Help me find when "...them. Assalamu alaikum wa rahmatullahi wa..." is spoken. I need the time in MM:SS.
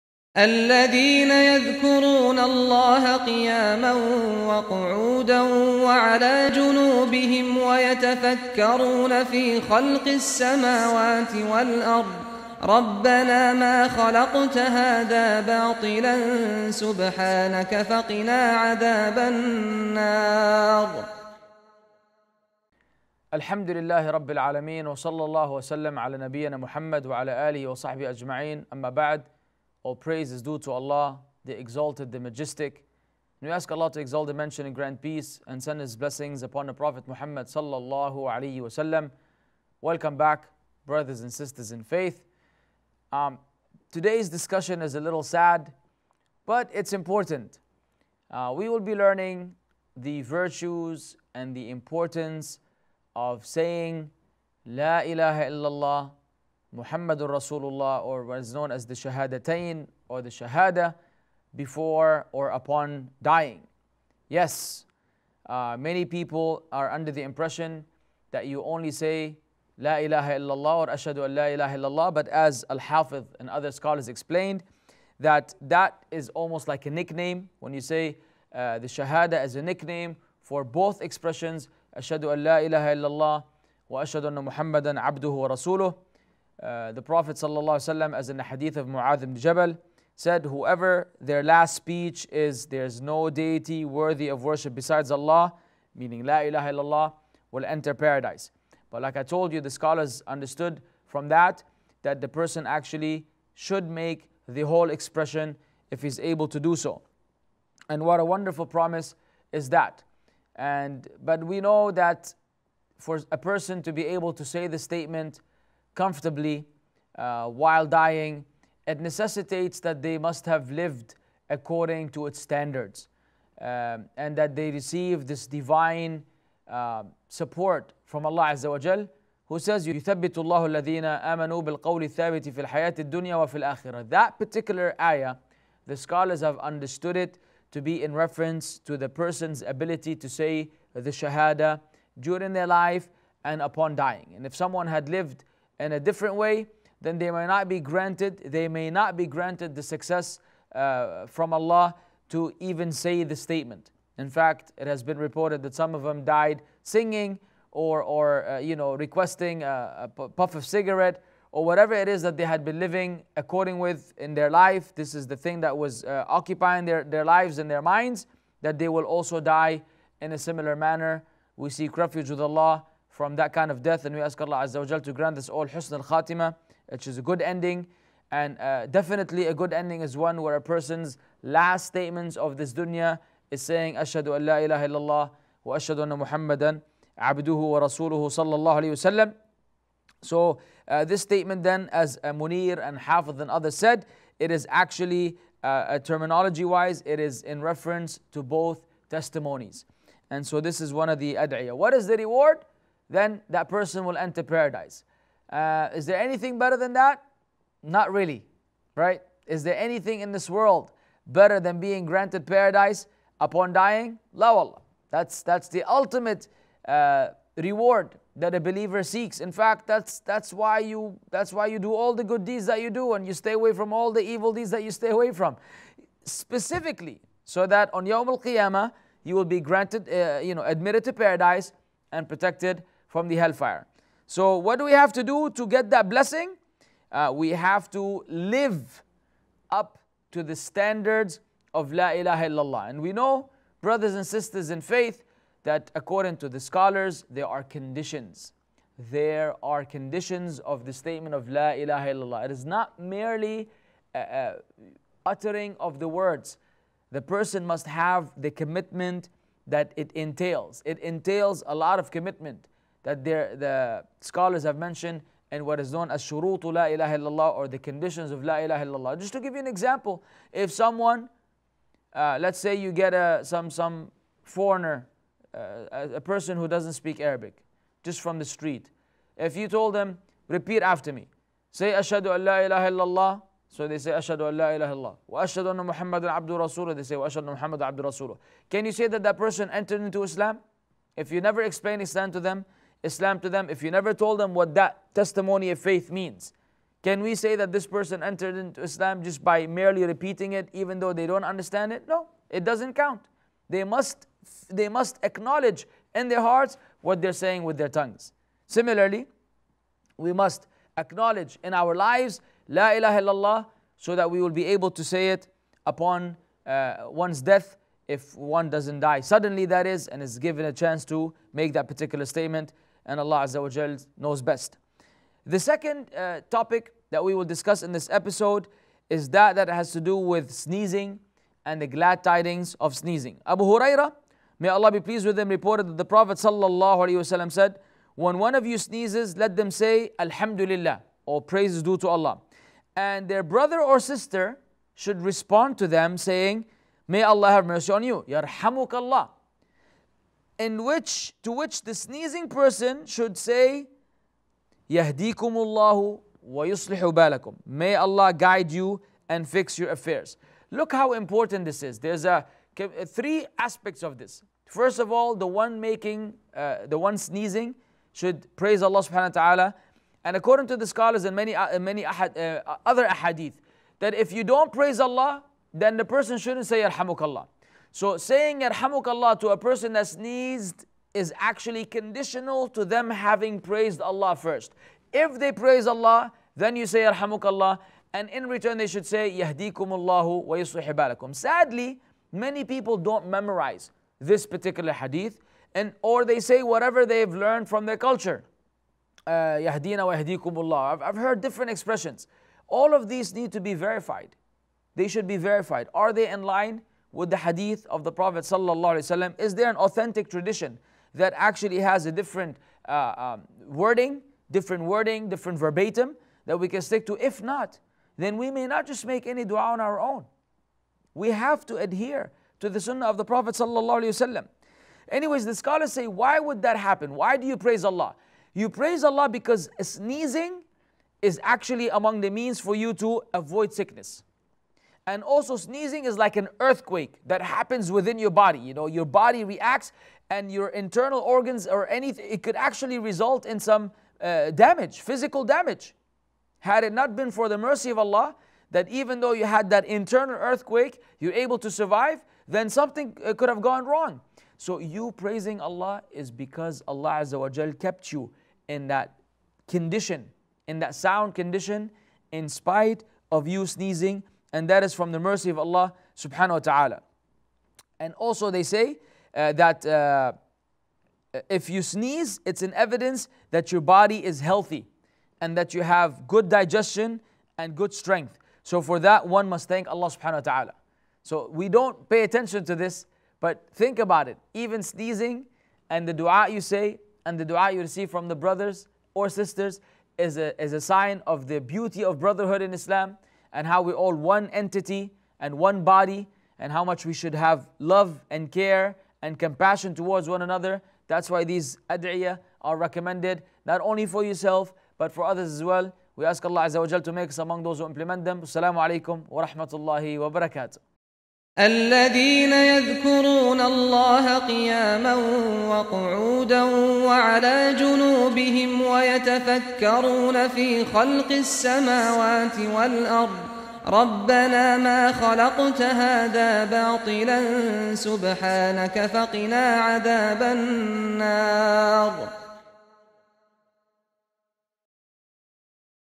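08:28.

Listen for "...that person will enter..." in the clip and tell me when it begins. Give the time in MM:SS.
03:23.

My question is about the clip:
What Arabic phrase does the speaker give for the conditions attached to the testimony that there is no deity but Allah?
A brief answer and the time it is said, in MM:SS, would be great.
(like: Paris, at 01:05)
shurutu la ilaha illallah, at 04:26.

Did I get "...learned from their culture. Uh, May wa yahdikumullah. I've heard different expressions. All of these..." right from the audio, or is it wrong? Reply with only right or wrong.
wrong.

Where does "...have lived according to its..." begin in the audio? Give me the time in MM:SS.
02:00.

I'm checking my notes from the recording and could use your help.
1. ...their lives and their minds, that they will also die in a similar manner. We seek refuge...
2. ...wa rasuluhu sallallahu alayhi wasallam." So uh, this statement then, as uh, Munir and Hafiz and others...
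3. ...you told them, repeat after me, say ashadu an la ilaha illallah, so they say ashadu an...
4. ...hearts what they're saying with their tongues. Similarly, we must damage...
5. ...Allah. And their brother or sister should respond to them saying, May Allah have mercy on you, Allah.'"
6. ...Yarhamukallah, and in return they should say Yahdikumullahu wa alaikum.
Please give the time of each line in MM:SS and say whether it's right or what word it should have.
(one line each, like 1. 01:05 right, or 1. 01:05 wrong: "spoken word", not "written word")
1. 02:47 right
2. 03:07 right
3. 04:39 right
4. 05:06 wrong: "acknowledge", not "damage"
5. 05:42 right
6. 06:27 wrong: "yuslihubalakum", not "alaikum".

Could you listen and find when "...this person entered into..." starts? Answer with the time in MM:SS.
04:57.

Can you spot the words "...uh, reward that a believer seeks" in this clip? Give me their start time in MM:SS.
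03:36.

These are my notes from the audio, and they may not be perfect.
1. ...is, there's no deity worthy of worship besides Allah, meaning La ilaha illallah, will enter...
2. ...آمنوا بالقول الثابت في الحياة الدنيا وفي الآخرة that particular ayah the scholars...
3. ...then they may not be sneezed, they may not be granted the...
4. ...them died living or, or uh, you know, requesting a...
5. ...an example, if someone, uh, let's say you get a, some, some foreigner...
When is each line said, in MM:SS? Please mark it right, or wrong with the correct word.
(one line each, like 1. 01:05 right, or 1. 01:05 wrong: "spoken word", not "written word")
1. 01:32 right
2. 02:11 right
3. 02:27 wrong: "granted", not "sneezed"
4. 02:36 wrong: "singing", not "living"
5. 04:29 right.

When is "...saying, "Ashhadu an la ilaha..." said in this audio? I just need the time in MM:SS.
03:03.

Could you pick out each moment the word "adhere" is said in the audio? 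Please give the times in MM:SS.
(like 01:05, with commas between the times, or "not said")
07:01.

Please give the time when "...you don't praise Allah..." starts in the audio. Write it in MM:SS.
06:14.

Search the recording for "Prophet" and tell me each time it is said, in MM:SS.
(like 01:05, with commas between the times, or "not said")
00:36, 01:27, 05:36, 06:48, 07:03.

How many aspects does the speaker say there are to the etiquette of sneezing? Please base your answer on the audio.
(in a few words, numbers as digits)
3.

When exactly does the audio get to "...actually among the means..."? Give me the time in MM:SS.
07:11.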